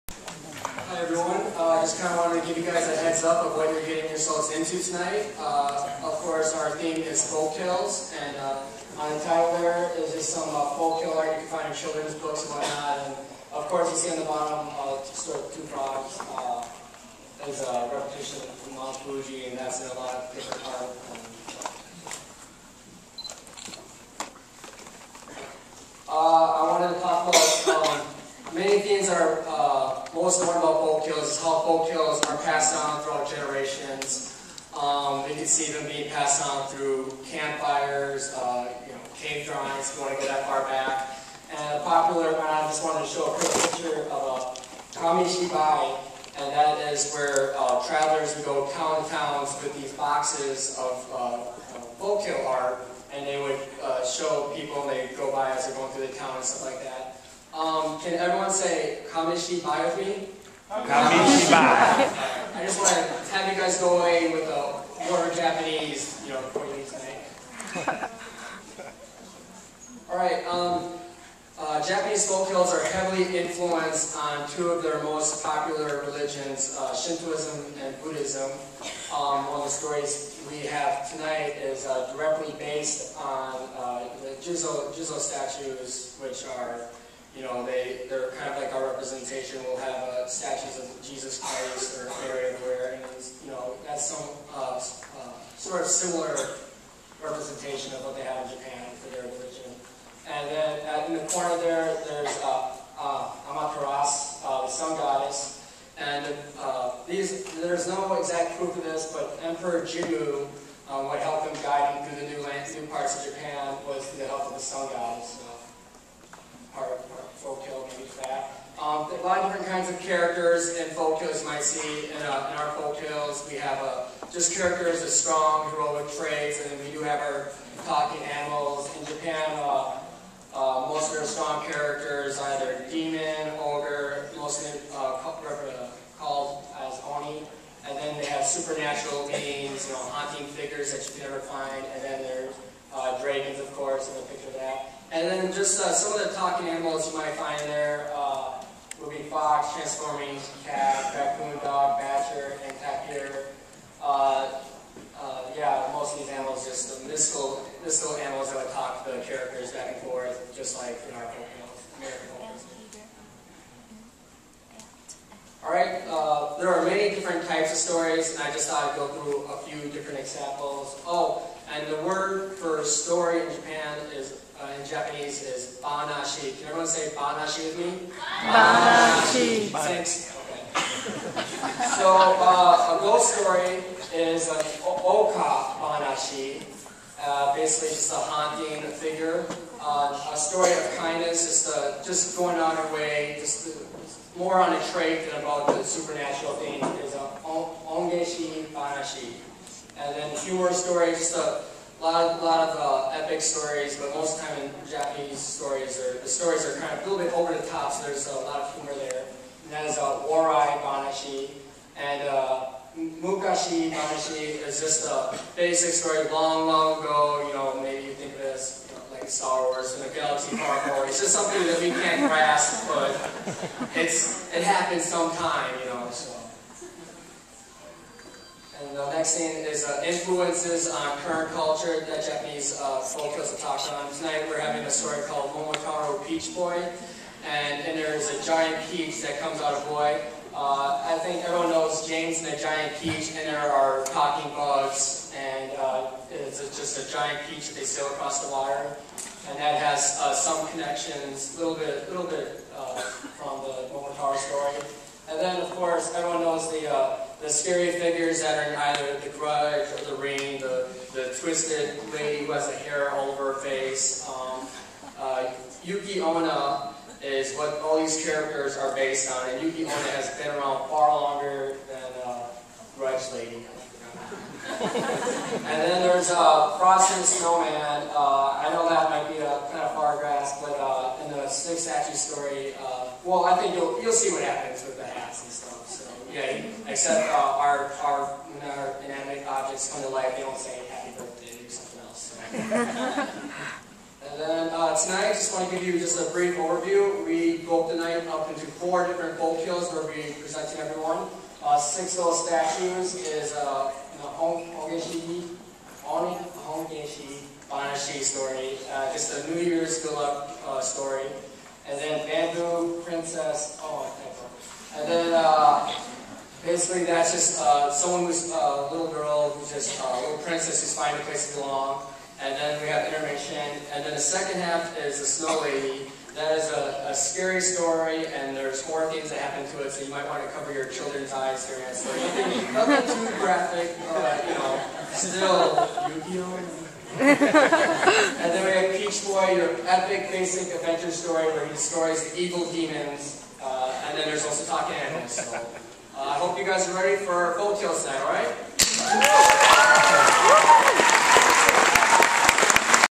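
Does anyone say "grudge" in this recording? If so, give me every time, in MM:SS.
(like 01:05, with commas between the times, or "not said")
04:19, 04:32.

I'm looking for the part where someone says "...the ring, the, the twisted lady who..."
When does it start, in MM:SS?
04:20.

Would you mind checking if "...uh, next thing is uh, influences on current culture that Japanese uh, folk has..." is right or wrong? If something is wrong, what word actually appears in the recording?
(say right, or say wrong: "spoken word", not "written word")
right.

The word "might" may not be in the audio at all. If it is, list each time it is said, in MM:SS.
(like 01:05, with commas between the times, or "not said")
02:01, 02:27, 04:39, 05:30.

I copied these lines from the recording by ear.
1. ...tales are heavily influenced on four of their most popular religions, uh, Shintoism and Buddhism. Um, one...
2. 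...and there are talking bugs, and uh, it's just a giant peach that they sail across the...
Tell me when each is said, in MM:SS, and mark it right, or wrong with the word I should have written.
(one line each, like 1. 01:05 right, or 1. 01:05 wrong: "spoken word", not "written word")
1. 01:12 wrong: "two", not "four"
2. 04:03 right.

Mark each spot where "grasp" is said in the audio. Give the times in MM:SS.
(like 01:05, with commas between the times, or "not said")
03:42, 04:40.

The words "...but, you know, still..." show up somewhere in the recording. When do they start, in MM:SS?
05:34.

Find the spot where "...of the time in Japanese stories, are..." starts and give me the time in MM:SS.
03:24.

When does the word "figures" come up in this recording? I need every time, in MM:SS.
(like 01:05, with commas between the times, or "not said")
02:20, 03:08, 04:17.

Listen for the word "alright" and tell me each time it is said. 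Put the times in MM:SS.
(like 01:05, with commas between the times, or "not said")
02:45, 05:48.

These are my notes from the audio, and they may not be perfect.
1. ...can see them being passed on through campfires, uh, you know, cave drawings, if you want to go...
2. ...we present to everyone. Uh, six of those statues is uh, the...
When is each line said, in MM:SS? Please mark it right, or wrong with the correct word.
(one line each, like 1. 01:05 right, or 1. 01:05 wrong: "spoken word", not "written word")
1. 00:35 right
2. 05:00 right.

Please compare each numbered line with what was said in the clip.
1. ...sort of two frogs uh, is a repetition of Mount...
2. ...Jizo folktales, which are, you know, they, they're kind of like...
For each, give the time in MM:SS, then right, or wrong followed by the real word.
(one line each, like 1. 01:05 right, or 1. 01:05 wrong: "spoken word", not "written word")
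1. 00:15 right
2. 01:24 wrong: "statues", not "folktales".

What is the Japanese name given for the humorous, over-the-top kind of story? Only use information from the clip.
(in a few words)
Warai Banashi.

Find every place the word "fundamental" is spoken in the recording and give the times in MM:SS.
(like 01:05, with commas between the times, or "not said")
not said.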